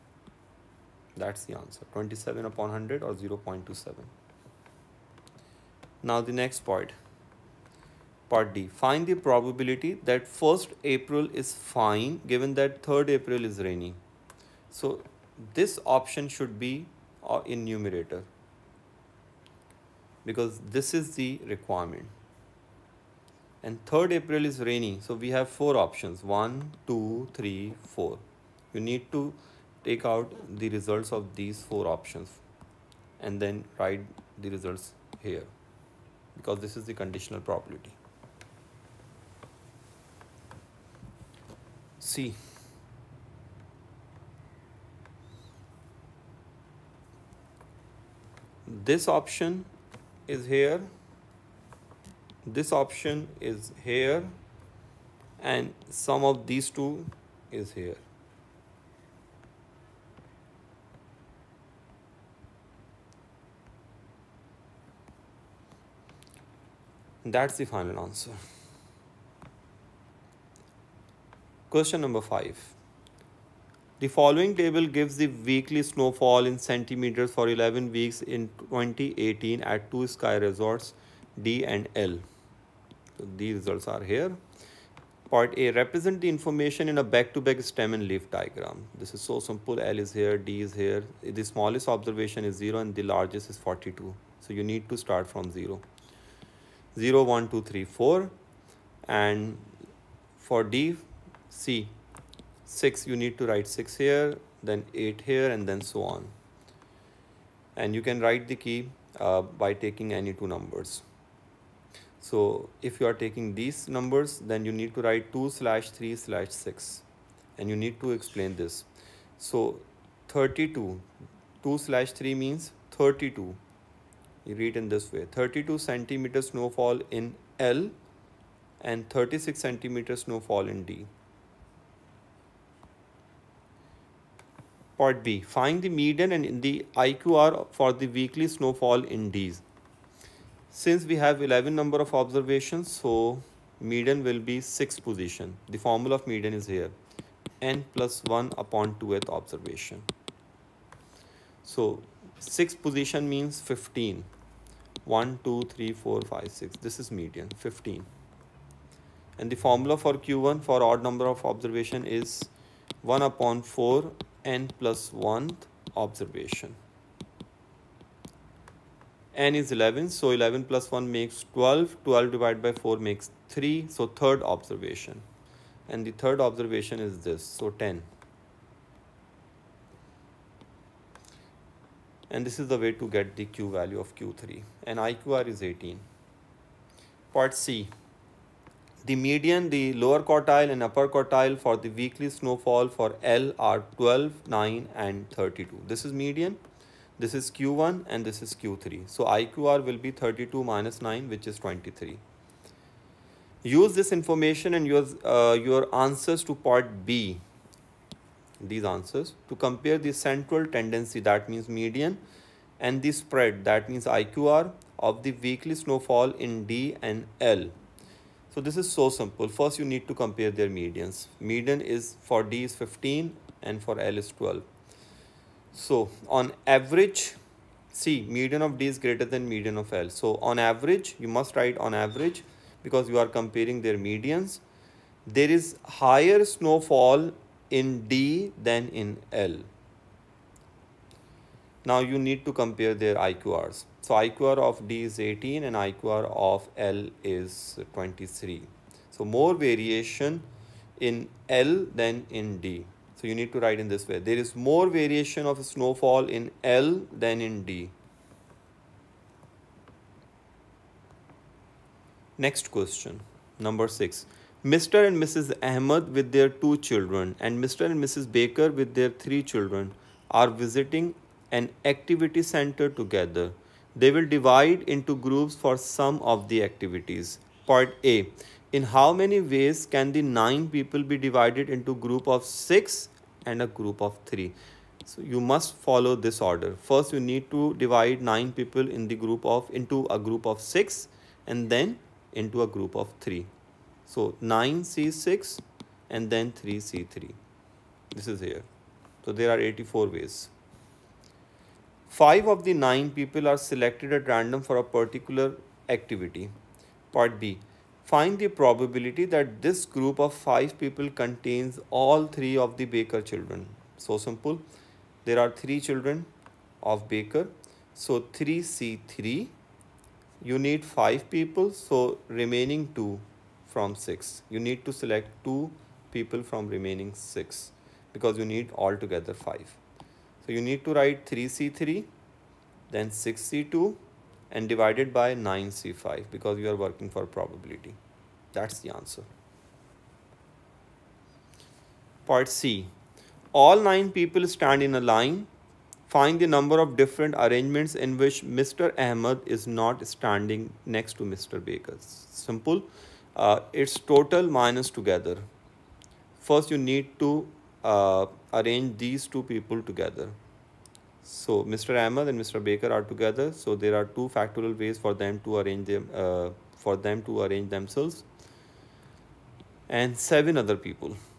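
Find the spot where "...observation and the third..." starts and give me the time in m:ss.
2:54.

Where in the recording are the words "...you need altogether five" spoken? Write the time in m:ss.
5:28.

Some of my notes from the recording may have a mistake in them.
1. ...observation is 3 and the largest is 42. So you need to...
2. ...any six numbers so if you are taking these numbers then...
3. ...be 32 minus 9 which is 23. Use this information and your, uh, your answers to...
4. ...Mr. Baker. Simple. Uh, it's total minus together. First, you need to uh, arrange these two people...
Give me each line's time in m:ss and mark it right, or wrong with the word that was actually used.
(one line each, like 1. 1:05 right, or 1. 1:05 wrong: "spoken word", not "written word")
1. 1:31 wrong: "0", not "3"
2. 1:50 wrong: "two", not "six"
3. 3:19 right
4. 5:51 right.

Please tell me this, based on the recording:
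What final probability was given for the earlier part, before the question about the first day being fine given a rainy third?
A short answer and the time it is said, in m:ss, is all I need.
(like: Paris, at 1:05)
0.27, at 0:03.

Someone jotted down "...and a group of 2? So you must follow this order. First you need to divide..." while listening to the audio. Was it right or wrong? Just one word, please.
wrong.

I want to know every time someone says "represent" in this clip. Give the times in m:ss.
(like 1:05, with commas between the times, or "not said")
1:25.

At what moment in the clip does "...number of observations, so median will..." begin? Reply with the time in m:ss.
2:21.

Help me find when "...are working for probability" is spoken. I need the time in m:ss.
5:36.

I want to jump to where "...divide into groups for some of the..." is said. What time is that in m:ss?
4:34.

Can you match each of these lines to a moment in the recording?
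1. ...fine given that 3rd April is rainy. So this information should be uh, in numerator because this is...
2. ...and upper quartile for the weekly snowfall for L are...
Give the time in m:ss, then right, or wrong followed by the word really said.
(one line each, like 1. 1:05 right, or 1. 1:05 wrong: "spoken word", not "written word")
1. 0:11 wrong: "option", not "information"
2. 3:10 right.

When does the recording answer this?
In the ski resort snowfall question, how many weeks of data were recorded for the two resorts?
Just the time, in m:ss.
1:17.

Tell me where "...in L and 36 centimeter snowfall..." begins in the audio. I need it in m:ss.
2:07.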